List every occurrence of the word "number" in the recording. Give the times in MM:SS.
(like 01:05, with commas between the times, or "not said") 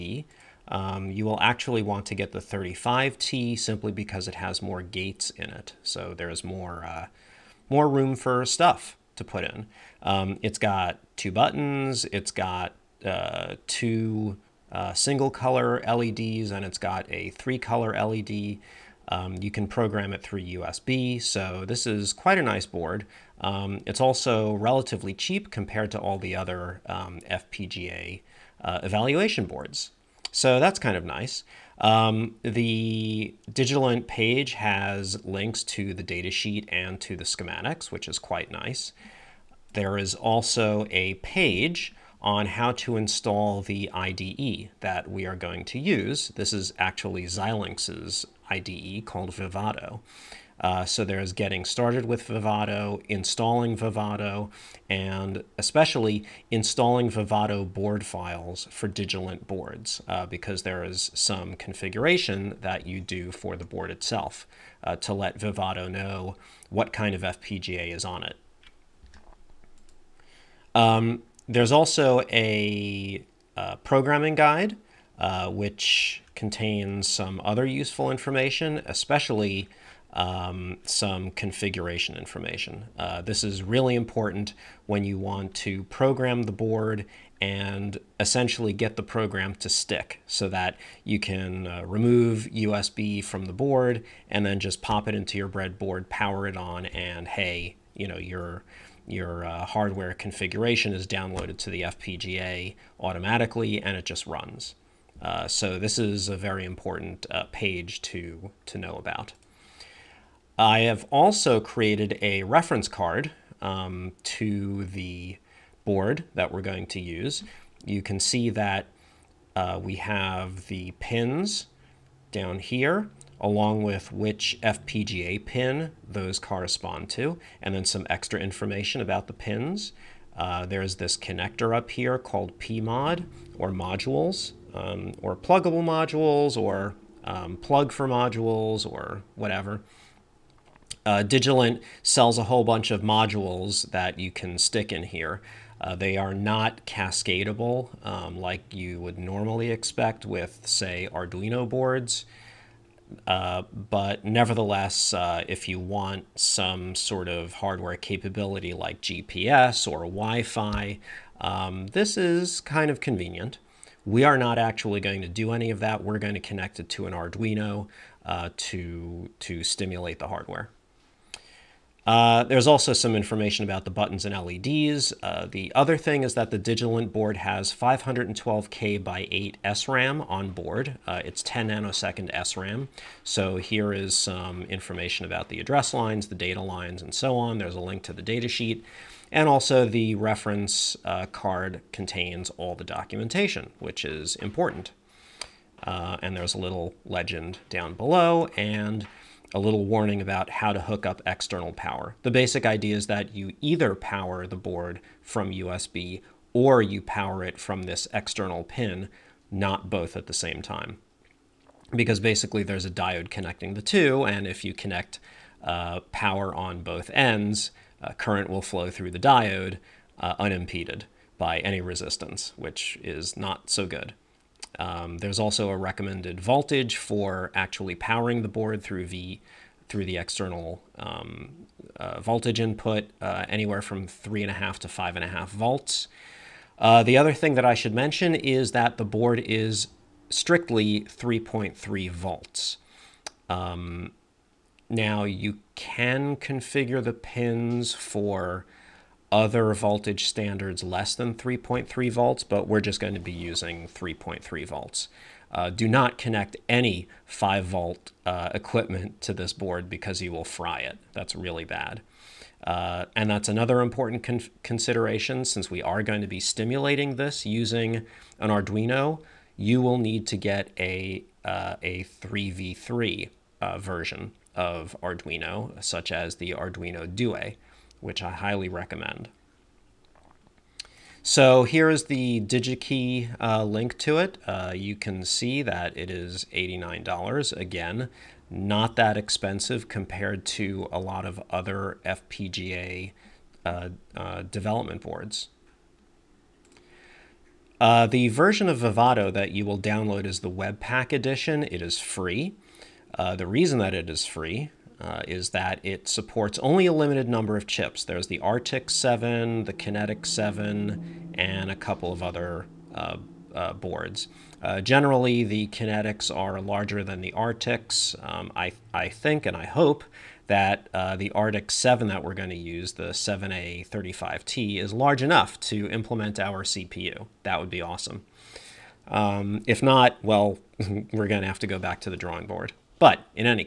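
05:07.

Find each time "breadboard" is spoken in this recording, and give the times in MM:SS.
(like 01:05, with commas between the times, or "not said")
01:35.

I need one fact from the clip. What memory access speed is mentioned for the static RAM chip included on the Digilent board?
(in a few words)
10 nanoseconds.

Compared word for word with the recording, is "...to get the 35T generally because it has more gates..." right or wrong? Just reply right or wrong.
wrong.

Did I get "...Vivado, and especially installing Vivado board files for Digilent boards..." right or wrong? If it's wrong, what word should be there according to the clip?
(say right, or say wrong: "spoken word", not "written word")
right.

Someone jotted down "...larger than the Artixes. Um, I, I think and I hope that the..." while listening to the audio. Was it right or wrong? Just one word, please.
right.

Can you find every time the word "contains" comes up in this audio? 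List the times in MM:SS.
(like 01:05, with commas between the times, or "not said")
01:16, 03:11.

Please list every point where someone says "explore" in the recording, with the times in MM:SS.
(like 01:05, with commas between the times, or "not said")
not said.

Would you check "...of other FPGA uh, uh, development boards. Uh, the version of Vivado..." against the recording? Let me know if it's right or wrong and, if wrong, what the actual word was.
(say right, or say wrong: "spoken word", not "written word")
right.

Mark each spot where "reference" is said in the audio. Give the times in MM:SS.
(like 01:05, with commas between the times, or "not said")
01:52, 03:10.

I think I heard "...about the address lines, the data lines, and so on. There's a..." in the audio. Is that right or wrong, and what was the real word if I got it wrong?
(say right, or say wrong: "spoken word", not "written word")
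right.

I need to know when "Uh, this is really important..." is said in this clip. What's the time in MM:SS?
01:22.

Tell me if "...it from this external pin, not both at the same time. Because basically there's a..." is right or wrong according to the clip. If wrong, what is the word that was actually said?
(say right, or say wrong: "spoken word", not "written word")
right.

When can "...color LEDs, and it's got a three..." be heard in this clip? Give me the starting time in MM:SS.
00:15.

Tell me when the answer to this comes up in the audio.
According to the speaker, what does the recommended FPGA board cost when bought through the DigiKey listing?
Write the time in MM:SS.
04:46.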